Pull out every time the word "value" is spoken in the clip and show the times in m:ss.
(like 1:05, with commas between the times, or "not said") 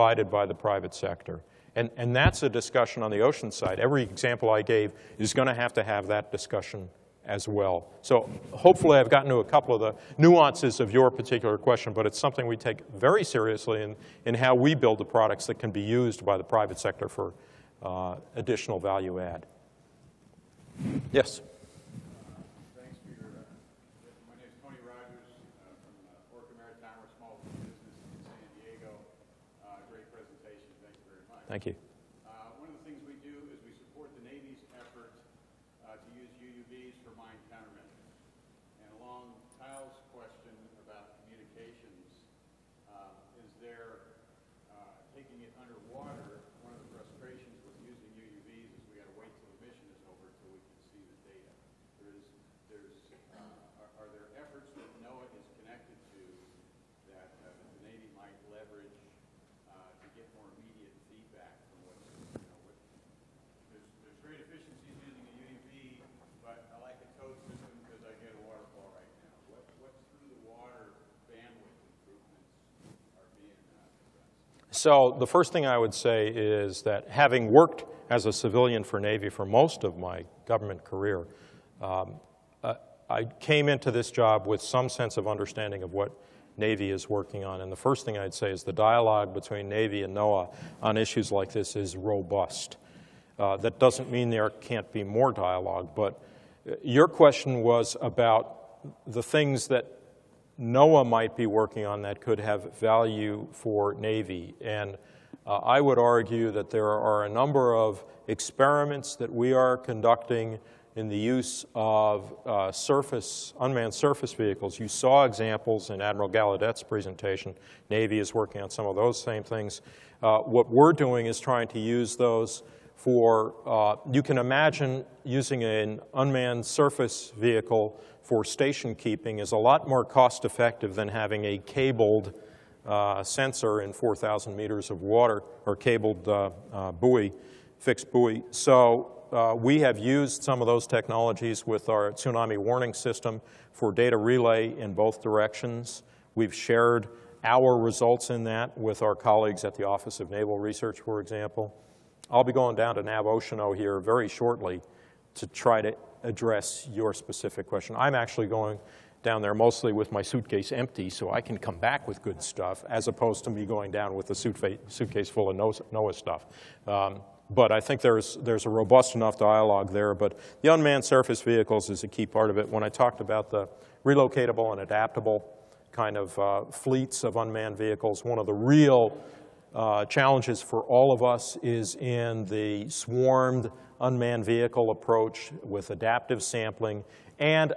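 0:18, 1:42.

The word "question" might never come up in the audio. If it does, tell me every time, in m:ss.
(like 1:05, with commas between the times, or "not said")
0:11, 1:37, 2:37.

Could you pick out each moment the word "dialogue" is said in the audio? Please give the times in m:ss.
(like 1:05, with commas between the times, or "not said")
1:28, 1:35, 2:49.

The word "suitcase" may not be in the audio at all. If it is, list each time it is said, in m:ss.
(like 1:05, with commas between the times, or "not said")
2:40, 2:44.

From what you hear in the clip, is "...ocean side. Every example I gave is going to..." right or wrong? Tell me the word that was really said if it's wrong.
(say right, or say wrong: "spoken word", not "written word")
right.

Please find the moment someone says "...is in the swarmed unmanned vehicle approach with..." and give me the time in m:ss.
3:01.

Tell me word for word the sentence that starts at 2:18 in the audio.
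So uh, we have used some of those technologies with our tsunami warning system for data relay in both directions.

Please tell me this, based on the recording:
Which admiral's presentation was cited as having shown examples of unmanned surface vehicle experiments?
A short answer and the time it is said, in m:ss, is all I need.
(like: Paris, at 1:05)
Admiral Gallaudet, at 1:56.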